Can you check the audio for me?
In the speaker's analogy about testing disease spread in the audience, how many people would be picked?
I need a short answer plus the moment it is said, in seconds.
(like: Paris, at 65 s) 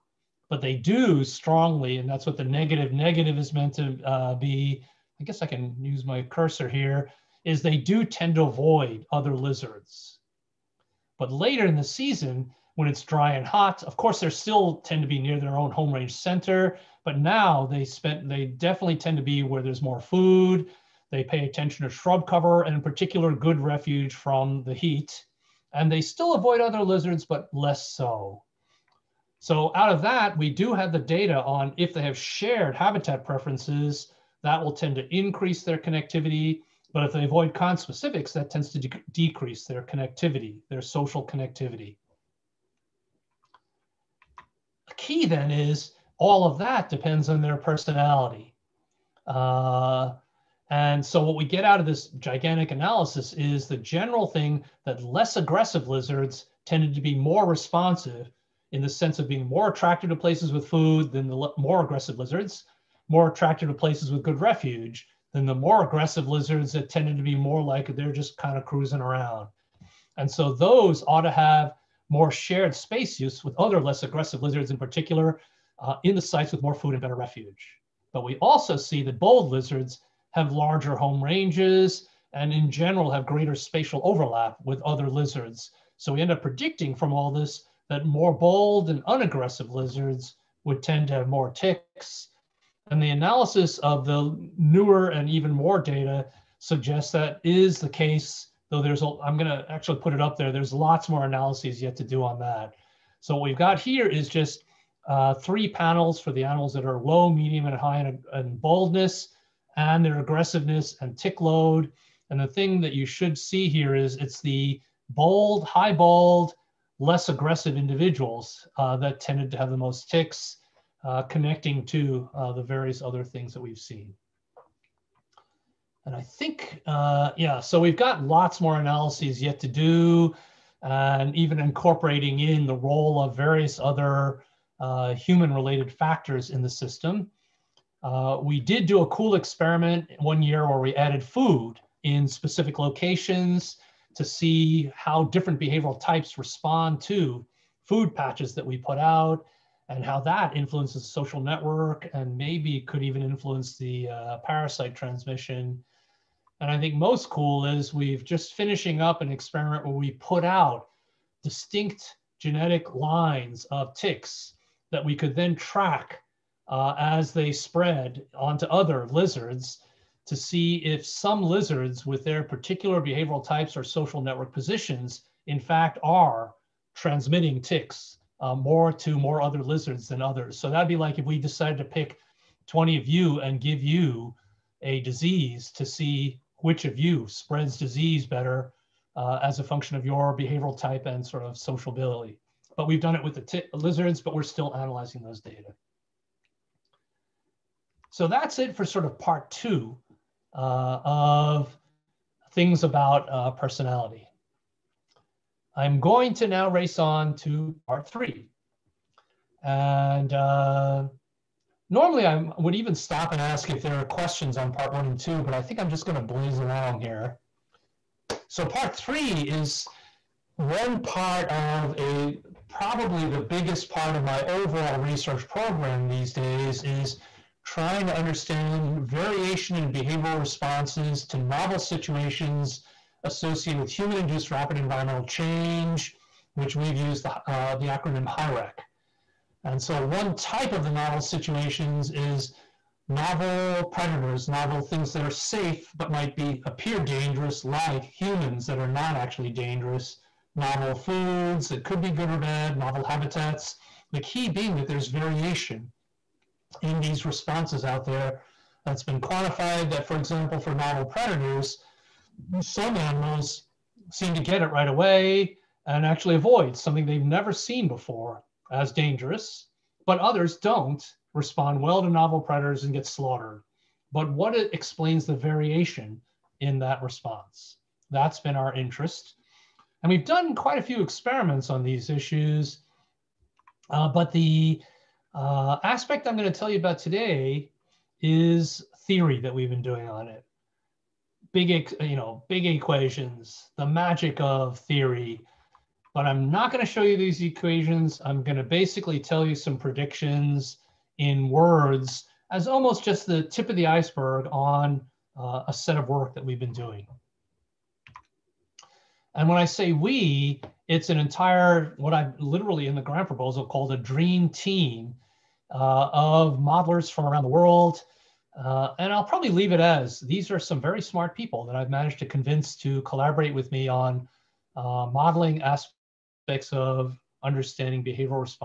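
20, at 182 s.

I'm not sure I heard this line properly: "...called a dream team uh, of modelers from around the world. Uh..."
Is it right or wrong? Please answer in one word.
right.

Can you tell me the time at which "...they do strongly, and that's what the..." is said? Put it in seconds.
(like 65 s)
0 s.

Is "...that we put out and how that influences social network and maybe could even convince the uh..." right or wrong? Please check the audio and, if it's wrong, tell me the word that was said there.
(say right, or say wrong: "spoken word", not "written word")
wrong: "influence", not "convince".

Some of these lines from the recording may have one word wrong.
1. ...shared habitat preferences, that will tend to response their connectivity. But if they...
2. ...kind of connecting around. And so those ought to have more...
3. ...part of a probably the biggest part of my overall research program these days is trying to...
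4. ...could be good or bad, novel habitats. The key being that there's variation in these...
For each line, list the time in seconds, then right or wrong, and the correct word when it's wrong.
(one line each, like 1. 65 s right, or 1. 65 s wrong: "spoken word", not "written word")
1. 32 s wrong: "increase", not "response"
2. 68 s wrong: "cruising", not "connecting"
3. 220 s right
4. 251 s right.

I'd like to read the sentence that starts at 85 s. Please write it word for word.
So we end up predicting from all this that more bold and unaggressive lizards would tend to have more ticks.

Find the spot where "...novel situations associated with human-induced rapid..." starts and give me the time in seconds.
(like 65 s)
231 s.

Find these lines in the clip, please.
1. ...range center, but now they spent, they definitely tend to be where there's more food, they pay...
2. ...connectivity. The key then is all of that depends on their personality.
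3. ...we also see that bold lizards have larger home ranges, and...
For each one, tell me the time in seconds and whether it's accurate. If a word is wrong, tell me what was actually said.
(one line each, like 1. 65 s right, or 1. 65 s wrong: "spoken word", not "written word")
1. 15 s right
2. 41 s right
3. 78 s right.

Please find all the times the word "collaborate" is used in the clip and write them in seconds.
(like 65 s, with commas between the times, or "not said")
323 s.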